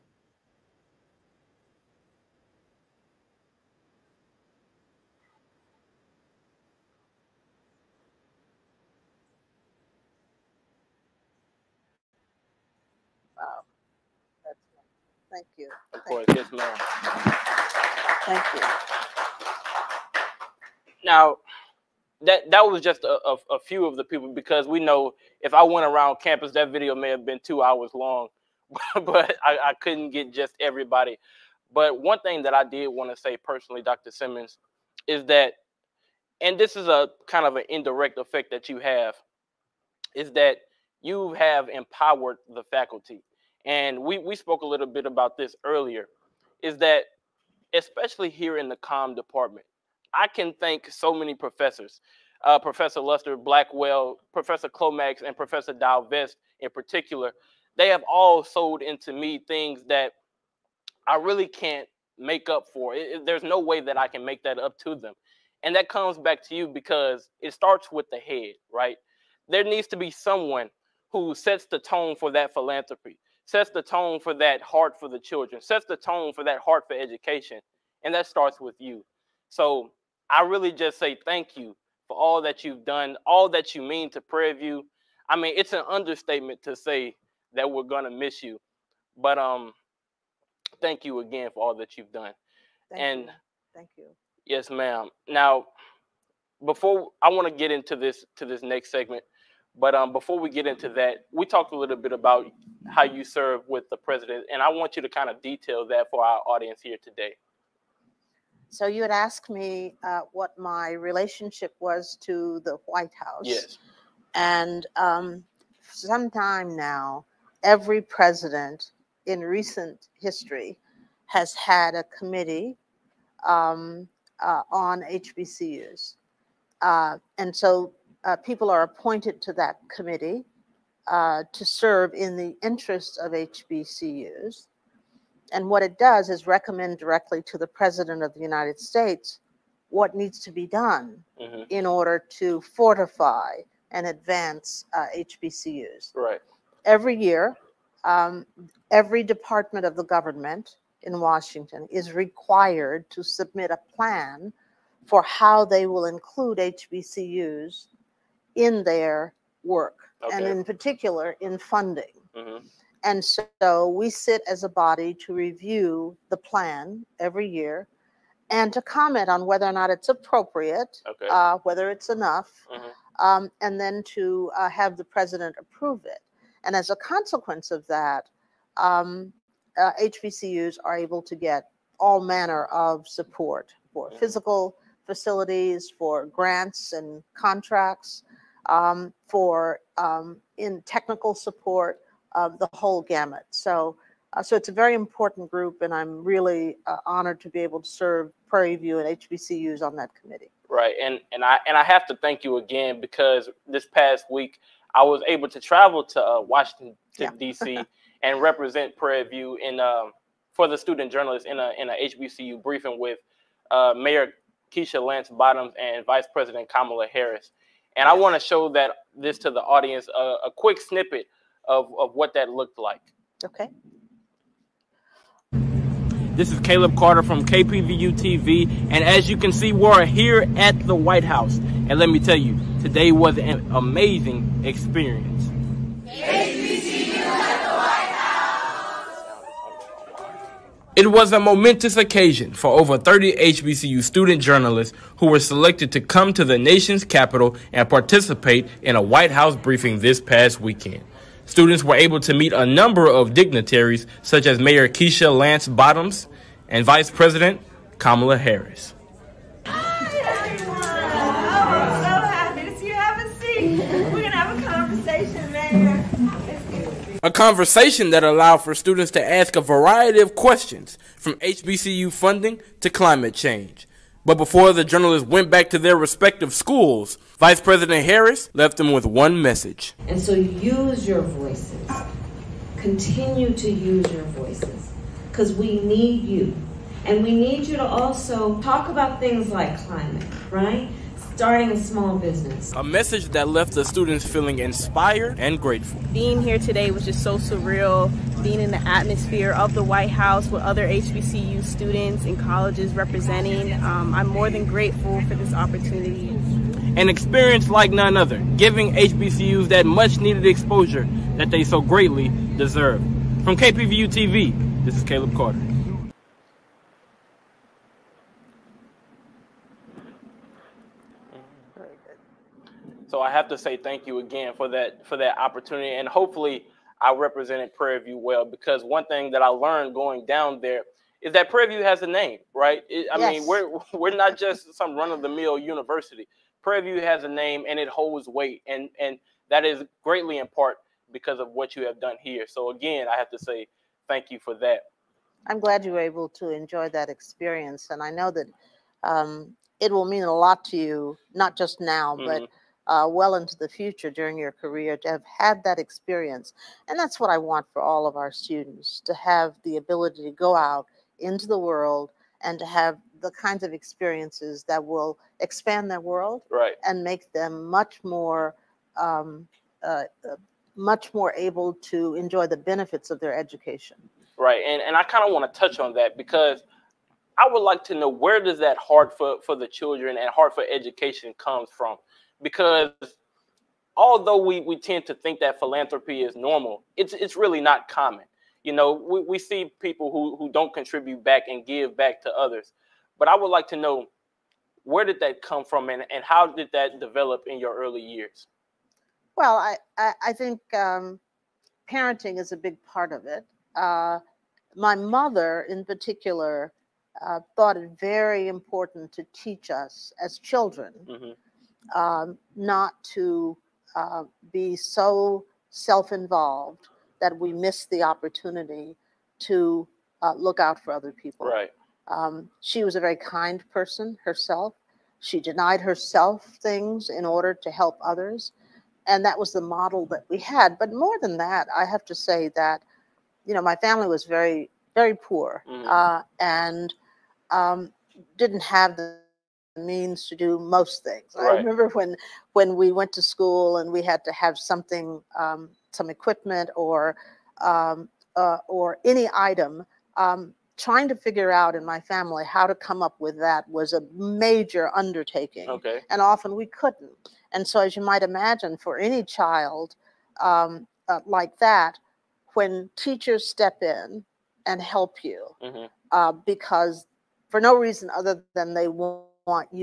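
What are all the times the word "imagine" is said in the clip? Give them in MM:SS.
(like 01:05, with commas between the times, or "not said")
07:38.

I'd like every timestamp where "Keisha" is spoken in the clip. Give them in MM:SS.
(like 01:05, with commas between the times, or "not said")
03:34, 04:14.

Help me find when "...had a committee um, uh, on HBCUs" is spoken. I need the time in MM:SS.
02:01.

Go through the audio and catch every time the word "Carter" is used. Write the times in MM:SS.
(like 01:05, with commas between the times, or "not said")
03:46, 05:15.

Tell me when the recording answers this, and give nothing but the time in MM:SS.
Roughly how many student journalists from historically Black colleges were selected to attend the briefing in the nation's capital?
04:02.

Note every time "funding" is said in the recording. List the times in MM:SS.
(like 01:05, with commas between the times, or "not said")
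02:41, 04:32.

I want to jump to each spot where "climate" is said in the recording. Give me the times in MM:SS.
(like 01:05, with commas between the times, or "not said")
04:32, 04:49.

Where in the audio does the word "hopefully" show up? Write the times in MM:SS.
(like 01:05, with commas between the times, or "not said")
05:26.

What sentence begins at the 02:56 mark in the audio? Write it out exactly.
And as a consequence of that, um, uh, HBCUs are able to get all manner of support for mm-hmm.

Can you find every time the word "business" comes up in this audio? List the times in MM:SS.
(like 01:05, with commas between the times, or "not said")
04:52.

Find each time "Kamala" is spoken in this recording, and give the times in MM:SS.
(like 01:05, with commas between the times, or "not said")
03:36, 04:17.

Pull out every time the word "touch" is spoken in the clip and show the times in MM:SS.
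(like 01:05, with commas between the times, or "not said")
06:15.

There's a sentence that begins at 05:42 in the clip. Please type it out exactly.
So again, I have to say thank you for that.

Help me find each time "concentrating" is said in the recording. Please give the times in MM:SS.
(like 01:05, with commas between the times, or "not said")
not said.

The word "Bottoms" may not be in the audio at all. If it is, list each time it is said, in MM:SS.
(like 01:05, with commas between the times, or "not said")
03:35, 04:15.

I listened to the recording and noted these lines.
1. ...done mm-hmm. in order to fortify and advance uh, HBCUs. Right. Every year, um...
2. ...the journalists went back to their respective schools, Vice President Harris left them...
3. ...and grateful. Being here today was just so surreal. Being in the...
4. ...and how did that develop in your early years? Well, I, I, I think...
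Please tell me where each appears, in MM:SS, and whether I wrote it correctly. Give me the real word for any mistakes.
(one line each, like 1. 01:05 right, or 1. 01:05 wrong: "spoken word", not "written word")
1. 02:20 right
2. 04:34 right
3. 04:55 right
4. 06:36 right.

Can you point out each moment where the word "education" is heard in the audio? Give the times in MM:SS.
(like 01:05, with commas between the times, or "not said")
01:16, 06:13, 06:20.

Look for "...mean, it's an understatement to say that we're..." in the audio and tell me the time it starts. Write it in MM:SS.
01:25.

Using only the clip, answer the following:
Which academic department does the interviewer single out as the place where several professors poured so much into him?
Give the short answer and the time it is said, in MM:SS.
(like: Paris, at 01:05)
Com department, at 00:48.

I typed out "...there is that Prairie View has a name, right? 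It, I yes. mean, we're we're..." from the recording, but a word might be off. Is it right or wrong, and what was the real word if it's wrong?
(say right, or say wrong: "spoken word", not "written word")
right.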